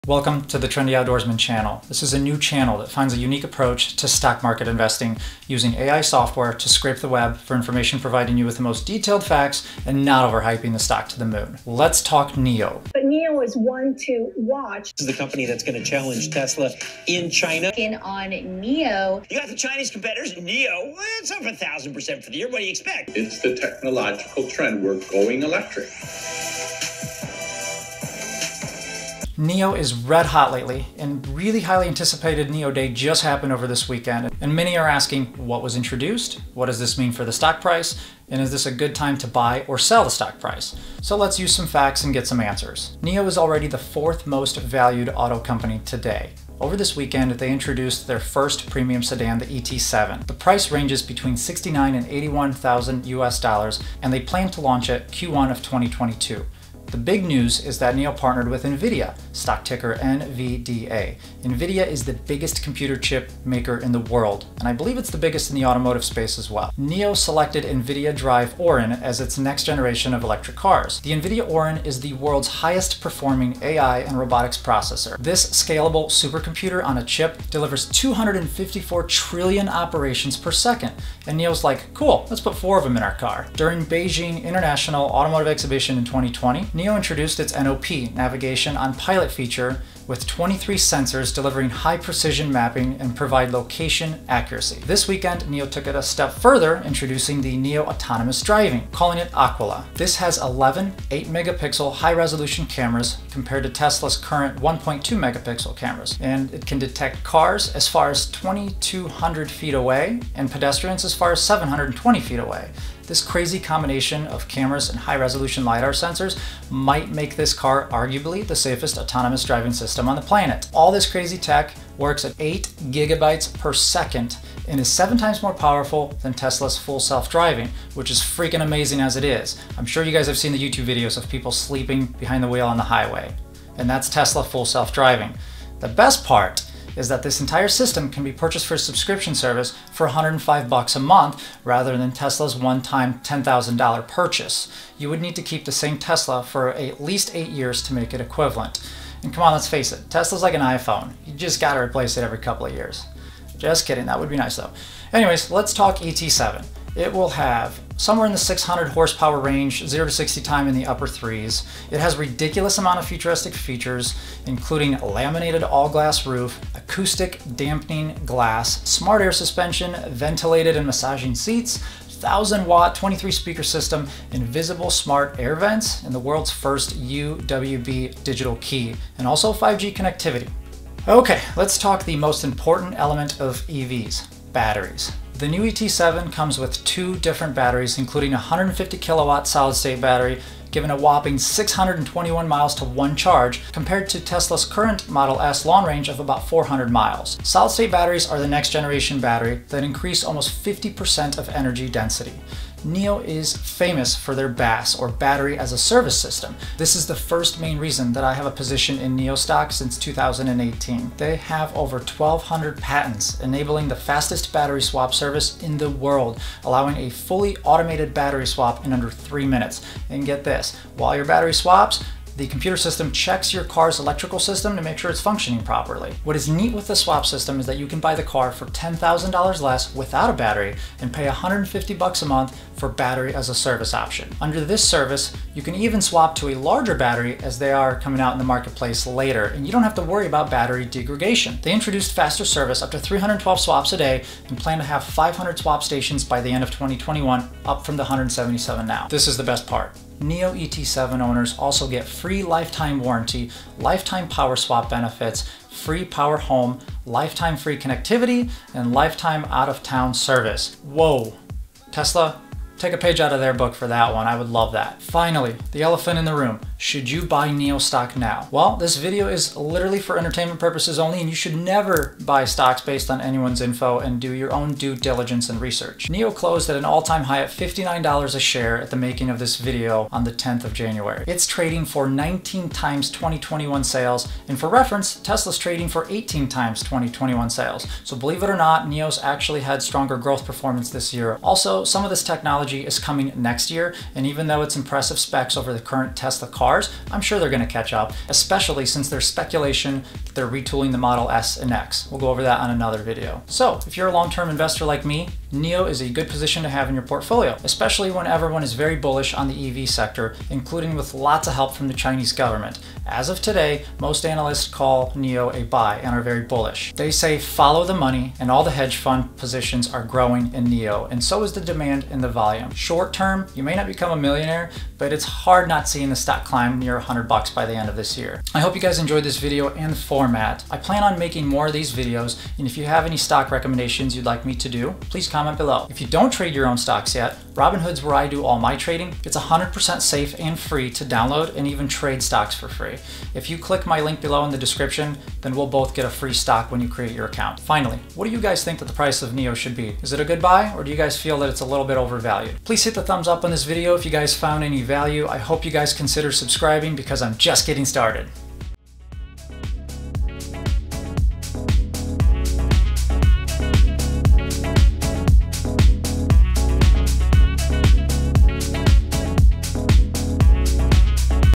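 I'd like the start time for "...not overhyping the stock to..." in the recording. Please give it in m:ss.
0:10.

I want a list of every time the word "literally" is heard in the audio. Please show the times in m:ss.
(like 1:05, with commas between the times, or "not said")
4:29.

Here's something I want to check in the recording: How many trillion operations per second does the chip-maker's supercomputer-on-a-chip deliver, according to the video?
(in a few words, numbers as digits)
254.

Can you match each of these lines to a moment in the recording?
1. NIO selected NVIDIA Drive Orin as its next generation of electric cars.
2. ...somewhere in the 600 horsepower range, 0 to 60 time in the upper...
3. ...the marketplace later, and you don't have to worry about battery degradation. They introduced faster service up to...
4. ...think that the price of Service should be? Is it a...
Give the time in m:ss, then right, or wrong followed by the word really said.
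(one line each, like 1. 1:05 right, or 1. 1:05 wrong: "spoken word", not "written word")
1. 1:06 right
2. 2:37 right
3. 3:58 right
4. 5:48 wrong: "NIO", not "Service".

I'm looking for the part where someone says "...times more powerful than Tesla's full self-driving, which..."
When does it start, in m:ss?
2:05.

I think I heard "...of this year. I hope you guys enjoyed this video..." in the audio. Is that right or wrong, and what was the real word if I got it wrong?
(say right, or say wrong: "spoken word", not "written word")
right.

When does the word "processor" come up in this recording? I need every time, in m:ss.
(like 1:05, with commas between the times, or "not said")
1:14.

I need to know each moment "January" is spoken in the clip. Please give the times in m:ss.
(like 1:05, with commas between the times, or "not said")
4:40.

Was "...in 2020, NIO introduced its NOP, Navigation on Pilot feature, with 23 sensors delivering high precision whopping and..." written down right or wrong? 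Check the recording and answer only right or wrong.
wrong.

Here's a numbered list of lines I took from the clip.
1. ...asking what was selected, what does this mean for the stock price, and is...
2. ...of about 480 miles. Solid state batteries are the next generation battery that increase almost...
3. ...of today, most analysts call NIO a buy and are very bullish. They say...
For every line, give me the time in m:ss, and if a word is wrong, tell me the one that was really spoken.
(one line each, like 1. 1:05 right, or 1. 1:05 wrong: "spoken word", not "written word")
1. 0:34 wrong: "introduced", not "selected"
2. 3:16 wrong: "400", not "480"
3. 5:13 right.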